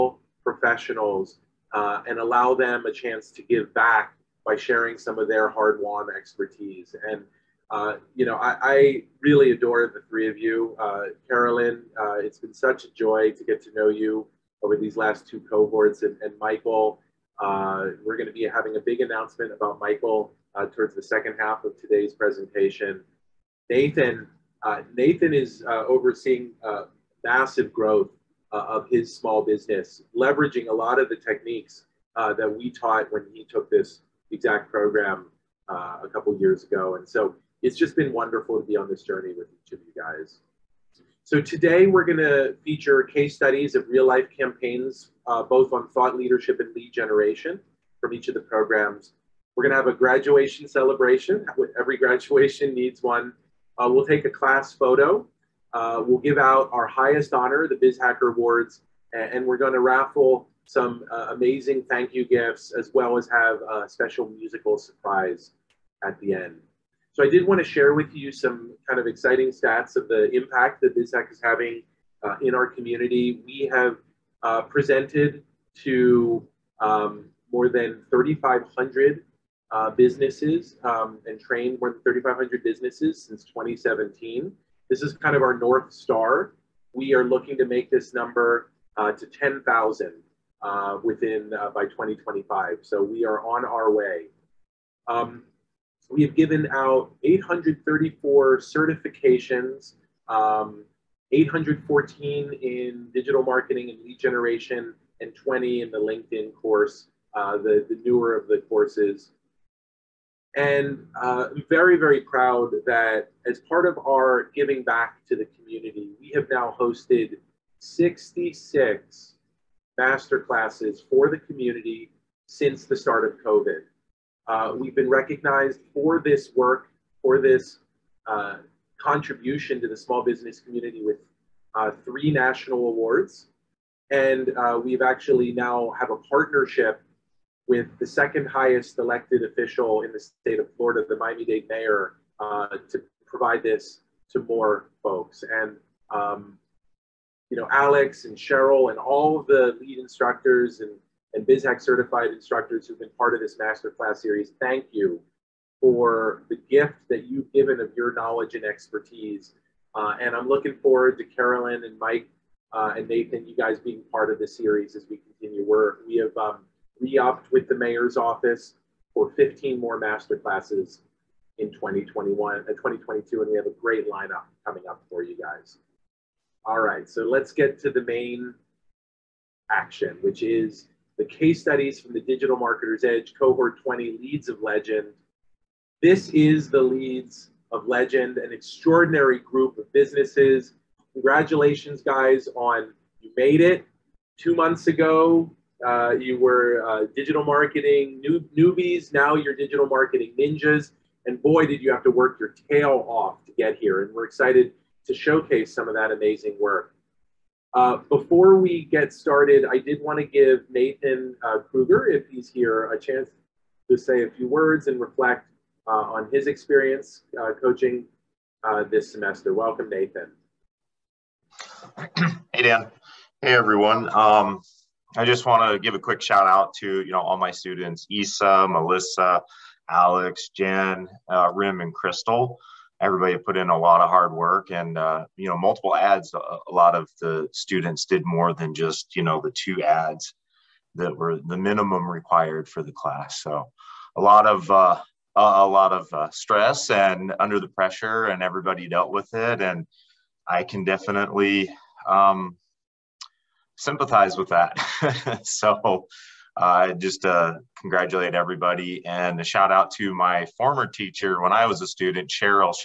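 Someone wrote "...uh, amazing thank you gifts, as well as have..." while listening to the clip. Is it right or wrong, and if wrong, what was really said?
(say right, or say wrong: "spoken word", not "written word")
right.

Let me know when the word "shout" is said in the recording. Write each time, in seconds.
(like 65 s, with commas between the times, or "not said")
226 s, 259 s.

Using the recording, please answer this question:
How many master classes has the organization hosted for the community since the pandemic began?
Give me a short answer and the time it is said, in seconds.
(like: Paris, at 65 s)
66, at 117 s.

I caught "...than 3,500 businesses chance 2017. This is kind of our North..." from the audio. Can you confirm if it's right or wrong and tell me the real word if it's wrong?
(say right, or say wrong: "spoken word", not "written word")
wrong: "since", not "chance".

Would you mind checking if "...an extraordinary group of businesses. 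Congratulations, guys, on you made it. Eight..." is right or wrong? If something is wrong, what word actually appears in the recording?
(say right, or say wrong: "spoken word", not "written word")
wrong: "Two", not "Eight".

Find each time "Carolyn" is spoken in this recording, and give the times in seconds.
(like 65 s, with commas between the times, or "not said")
11 s, 161 s.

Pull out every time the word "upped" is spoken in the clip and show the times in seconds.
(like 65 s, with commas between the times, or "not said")
166 s.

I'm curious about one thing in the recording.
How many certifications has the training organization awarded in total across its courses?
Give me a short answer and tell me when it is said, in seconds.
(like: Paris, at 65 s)
834, at 97 s.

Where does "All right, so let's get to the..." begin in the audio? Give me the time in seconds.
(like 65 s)
176 s.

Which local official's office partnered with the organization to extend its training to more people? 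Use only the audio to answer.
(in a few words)
Miami-Dade mayor.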